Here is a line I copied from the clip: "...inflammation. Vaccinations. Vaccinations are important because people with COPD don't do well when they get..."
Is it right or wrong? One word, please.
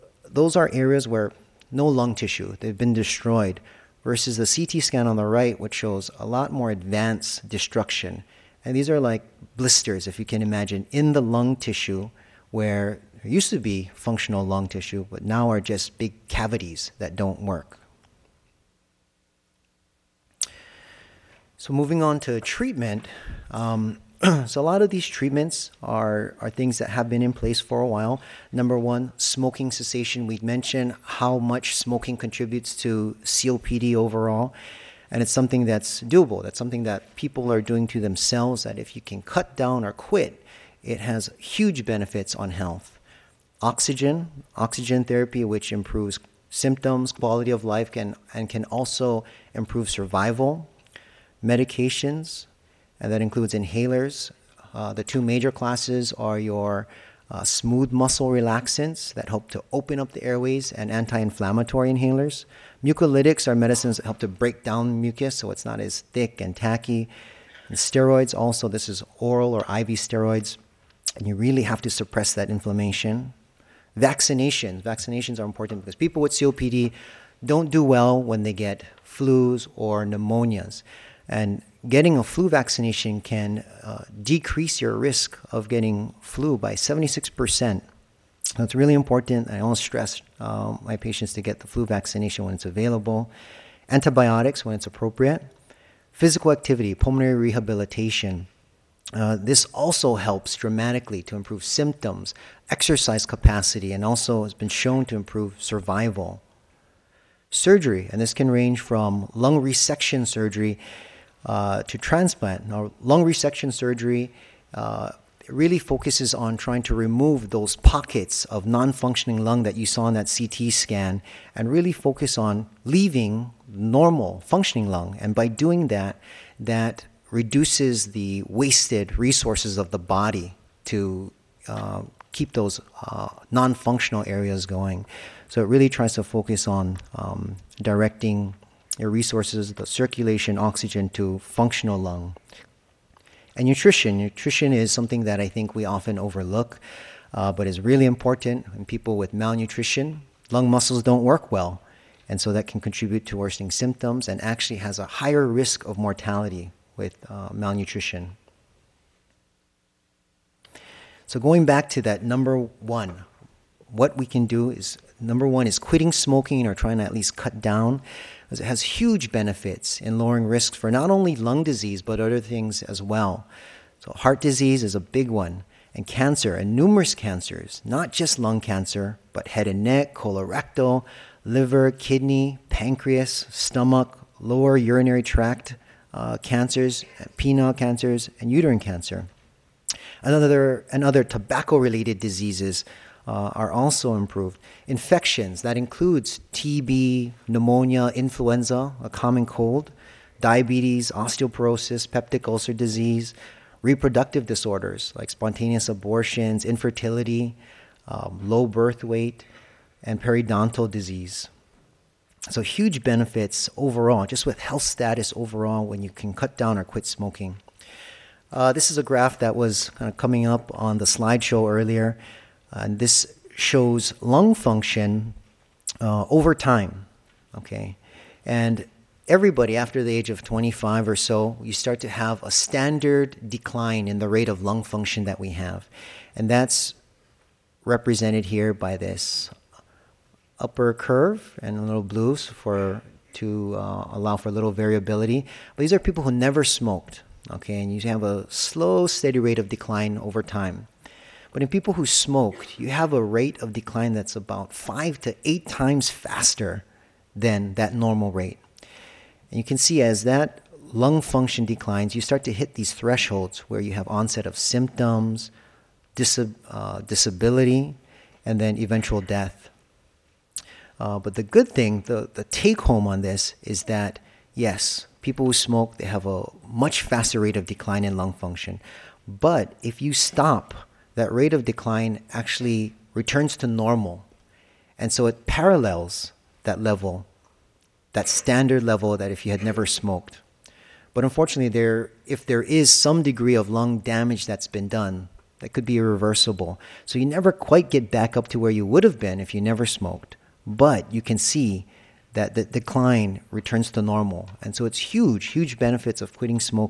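right.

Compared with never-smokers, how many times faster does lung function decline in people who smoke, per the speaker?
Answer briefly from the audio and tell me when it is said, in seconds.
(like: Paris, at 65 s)
5 to 8 times, at 254 s.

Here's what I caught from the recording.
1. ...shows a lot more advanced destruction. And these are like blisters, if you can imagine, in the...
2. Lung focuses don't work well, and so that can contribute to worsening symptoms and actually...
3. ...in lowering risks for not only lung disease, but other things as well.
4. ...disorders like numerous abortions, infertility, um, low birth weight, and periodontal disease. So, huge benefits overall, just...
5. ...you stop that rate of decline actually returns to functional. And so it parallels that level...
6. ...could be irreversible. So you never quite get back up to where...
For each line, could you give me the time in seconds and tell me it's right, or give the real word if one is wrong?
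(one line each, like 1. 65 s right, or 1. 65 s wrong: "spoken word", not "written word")
1. 5 s right
2. 150 s wrong: "muscles", not "focuses"
3. 170 s right
4. 204 s wrong: "spontaneous", not "numerous"
5. 280 s wrong: "normal", not "functional"
6. 295 s right.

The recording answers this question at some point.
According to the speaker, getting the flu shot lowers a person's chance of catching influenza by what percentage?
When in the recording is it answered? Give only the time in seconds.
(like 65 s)
86 s.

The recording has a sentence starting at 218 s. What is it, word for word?
Uh, this is a graph that was kind of coming up on the slideshow earlier.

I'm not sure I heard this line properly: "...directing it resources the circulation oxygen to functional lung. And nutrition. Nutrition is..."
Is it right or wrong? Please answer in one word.
right.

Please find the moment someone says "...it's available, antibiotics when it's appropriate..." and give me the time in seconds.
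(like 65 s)
92 s.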